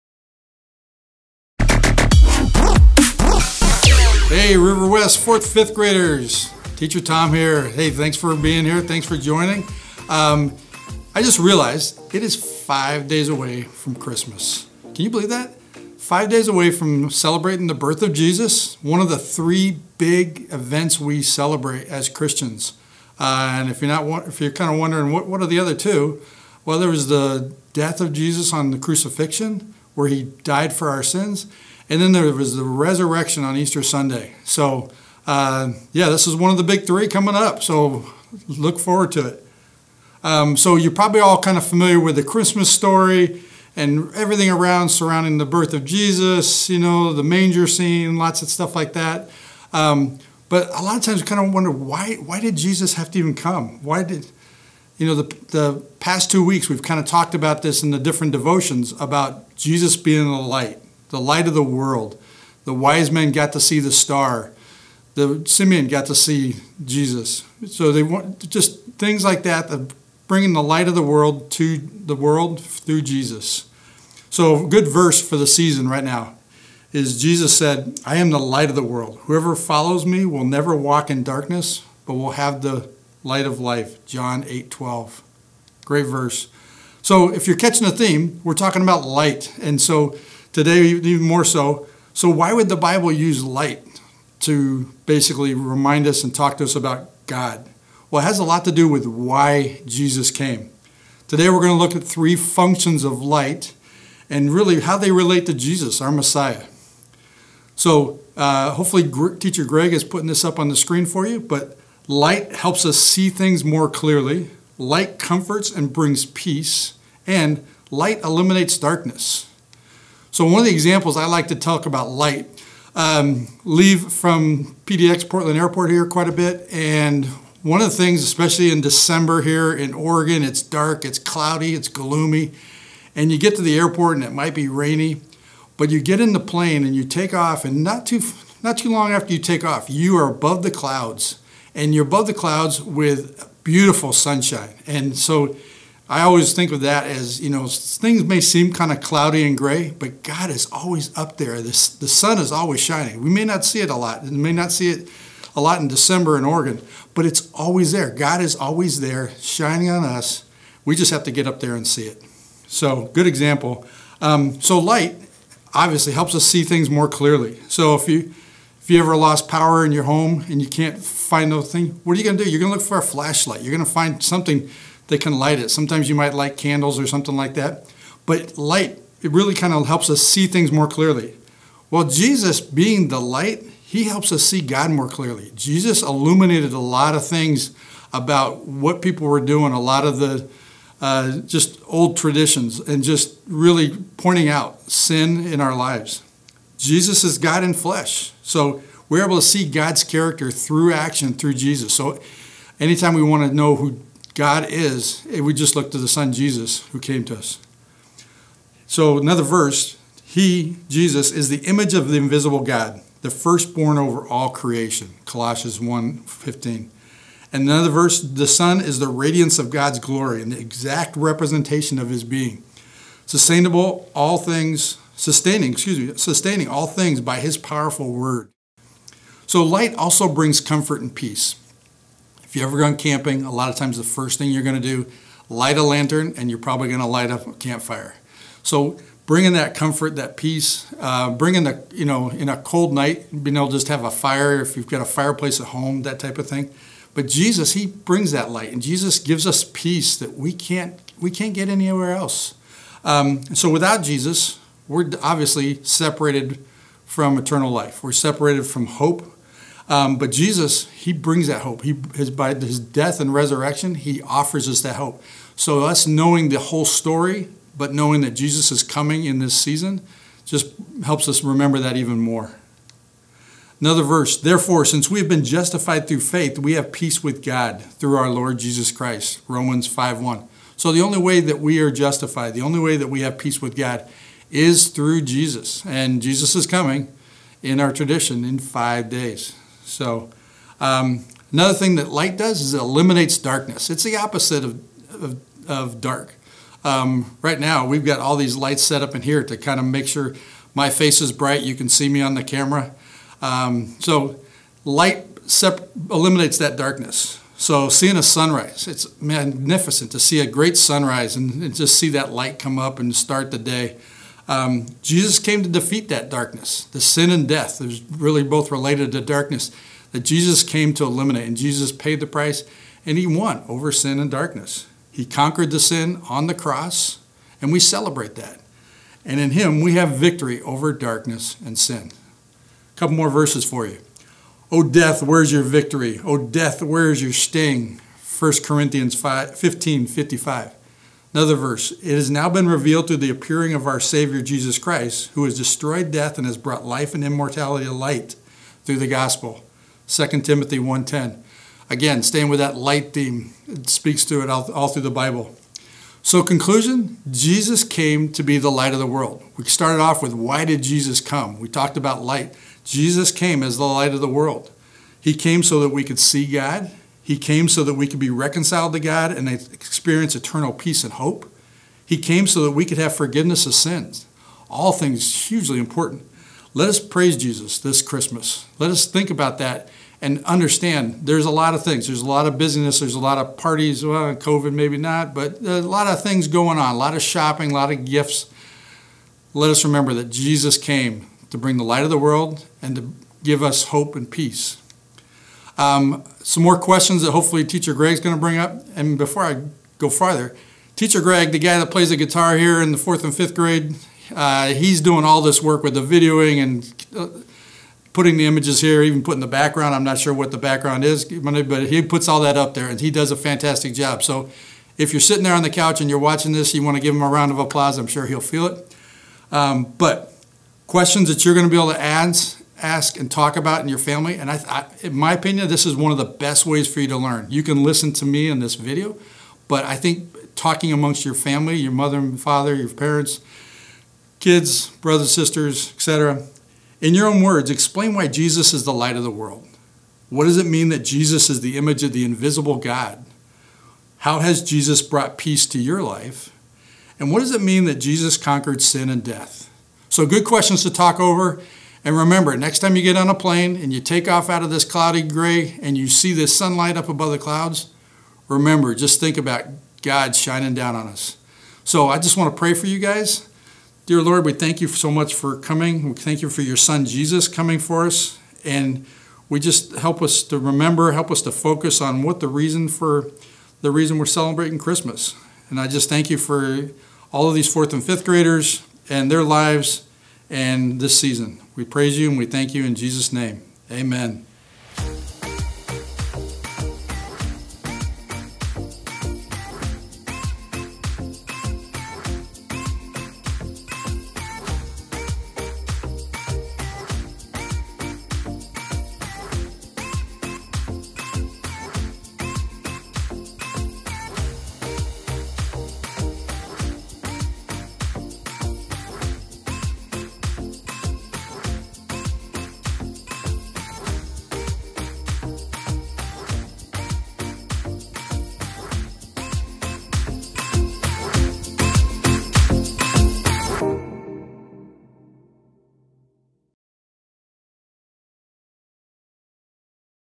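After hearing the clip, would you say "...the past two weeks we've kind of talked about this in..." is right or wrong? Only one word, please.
right.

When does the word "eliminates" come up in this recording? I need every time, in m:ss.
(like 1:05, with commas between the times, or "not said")
1:58, 4:52, 5:06, 5:21.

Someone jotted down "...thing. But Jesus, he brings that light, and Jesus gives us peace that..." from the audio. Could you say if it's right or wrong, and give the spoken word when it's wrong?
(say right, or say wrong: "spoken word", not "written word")
right.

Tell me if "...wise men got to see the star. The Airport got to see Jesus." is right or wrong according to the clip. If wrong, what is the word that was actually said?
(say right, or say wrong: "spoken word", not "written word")
wrong: "Simeon", not "Airport".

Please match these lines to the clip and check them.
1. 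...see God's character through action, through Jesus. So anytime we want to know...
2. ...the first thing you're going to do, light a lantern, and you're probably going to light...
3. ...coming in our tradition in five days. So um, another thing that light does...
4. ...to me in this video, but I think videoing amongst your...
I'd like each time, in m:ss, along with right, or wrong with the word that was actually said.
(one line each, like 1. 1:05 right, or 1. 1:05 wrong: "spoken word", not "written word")
1. 3:19 right
2. 3:53 right
3. 4:46 right
4. 7:08 wrong: "talking", not "videoing".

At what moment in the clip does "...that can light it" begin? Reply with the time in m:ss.
2:55.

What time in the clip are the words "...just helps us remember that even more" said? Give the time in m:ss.
4:30.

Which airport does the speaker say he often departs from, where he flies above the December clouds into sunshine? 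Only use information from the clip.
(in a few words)
PDX Portland Airport.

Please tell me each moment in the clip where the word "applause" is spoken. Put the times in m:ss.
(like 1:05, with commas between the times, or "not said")
6:57.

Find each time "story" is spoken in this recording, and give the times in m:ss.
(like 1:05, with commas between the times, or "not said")
0:42, 4:26.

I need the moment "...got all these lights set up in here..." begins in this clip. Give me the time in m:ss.
4:58.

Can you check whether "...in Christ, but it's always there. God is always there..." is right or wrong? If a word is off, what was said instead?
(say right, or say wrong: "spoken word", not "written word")
wrong: "Oregon", not "Christ".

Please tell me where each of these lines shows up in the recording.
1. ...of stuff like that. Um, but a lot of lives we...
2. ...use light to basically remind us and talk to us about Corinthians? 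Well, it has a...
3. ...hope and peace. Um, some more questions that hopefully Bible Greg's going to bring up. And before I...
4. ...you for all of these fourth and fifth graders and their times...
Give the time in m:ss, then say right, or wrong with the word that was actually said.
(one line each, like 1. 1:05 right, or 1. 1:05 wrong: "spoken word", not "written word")
1. 0:48 wrong: "times", not "lives"
2. 1:33 wrong: "God", not "Corinthians"
3. 6:33 wrong: "Teacher", not "Bible"
4. 7:56 wrong: "lives", not "times".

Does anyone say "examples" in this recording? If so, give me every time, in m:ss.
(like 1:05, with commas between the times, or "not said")
2:00, 2:43.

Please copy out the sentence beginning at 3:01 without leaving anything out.
Well, Jesus being the light, he helps us see God more clearly.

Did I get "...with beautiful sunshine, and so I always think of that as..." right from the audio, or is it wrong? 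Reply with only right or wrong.
right.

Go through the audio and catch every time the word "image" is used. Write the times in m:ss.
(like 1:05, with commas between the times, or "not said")
3:31, 6:48, 7:21.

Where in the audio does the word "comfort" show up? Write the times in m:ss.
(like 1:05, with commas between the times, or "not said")
1:55, 3:50, 3:59.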